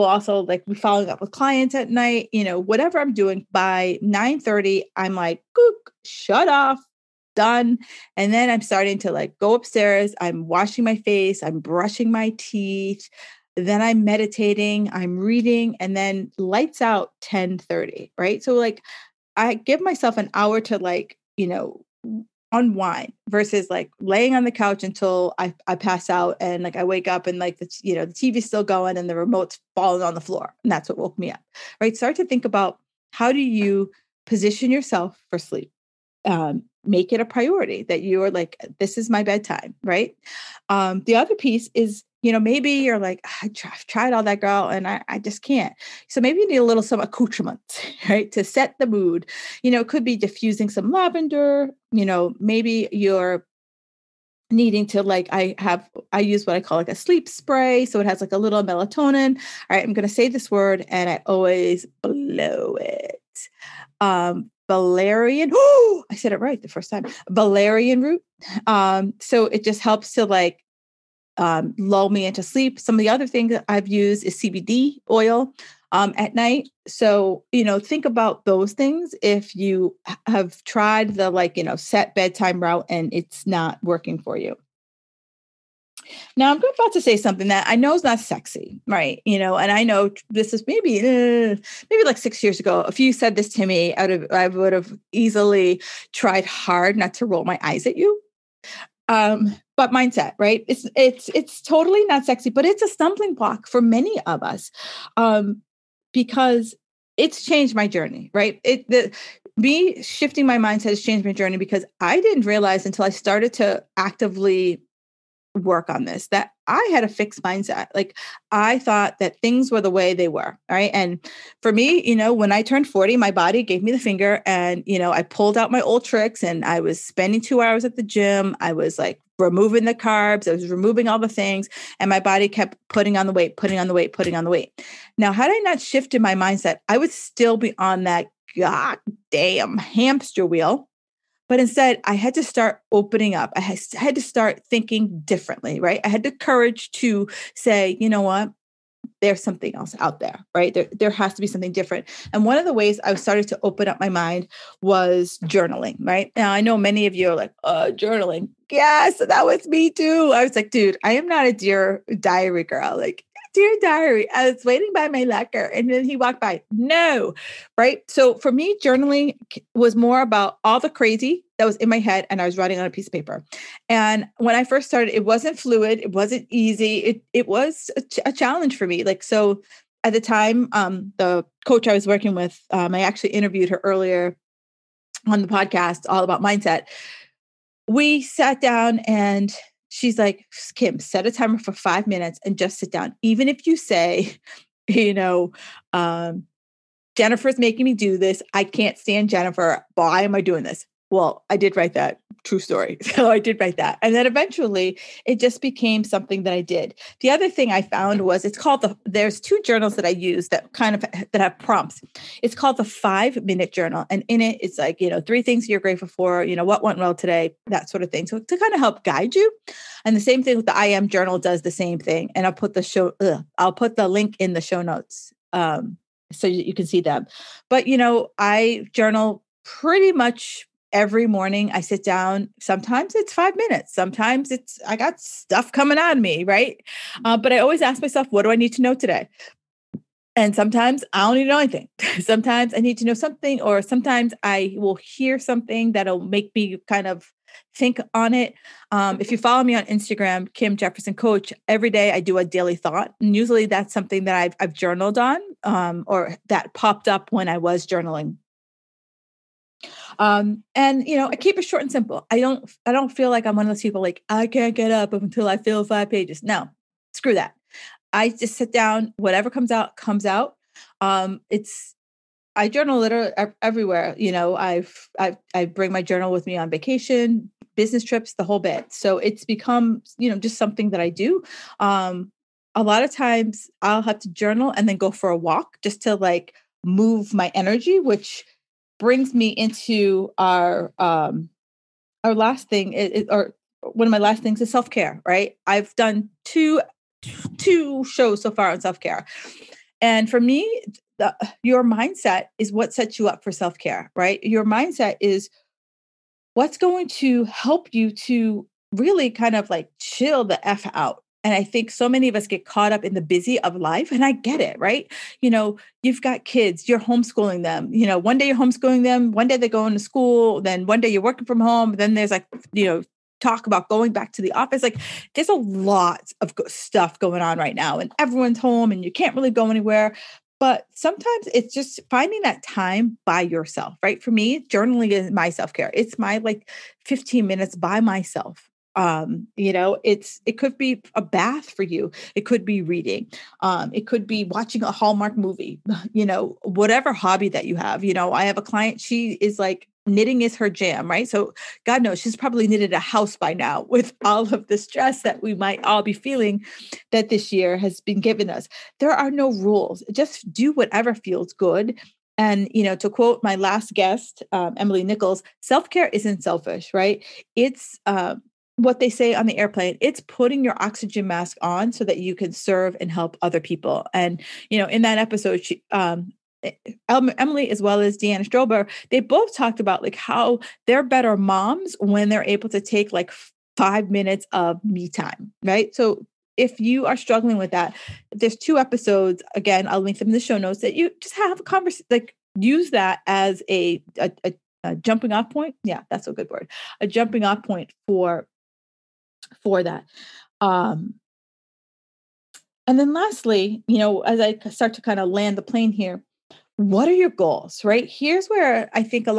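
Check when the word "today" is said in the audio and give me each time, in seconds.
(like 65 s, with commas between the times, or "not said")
217 s, 238 s.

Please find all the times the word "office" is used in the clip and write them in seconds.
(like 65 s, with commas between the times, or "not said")
324 s.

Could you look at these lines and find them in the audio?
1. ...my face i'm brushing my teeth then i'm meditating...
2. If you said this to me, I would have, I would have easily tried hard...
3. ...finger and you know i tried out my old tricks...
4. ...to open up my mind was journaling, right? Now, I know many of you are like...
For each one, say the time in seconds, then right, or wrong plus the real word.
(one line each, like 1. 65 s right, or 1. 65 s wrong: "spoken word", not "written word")
1. 10 s right
2. 92 s right
3. 123 s wrong: "pulled", not "tried"
4. 153 s right.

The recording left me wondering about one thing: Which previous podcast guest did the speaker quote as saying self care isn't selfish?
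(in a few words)
Emily Nichols.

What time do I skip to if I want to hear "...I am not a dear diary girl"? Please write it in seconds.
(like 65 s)
161 s.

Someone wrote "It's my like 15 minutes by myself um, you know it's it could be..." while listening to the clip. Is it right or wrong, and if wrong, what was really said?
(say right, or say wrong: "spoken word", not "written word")
right.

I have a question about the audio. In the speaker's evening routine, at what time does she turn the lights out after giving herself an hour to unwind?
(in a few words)
10:30.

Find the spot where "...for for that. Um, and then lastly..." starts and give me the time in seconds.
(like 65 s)
398 s.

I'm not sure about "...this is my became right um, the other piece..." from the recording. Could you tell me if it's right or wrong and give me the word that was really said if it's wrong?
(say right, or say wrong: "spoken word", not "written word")
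wrong: "bedtime", not "became".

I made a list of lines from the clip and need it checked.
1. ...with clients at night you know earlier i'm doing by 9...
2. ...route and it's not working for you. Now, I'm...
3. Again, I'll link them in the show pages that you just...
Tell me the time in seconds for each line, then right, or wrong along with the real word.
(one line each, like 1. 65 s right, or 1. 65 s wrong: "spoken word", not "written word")
1. 1 s wrong: "whatever", not "earlier"
2. 82 s right
3. 389 s wrong: "notes", not "pages".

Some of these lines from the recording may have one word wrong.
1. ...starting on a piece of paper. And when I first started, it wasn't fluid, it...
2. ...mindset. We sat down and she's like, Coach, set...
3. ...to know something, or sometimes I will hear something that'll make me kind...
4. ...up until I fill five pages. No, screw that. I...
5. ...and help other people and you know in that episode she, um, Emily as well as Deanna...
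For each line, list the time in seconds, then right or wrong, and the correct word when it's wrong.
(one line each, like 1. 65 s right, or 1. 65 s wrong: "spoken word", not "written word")
1. 172 s wrong: "writing", not "starting"
2. 186 s wrong: "Kim", not "Coach"
3. 242 s right
4. 264 s right
5. 372 s right.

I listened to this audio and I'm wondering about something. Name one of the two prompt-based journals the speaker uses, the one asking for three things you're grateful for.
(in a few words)
The 5 Minute Journal.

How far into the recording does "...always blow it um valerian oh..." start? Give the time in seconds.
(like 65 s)
61 s.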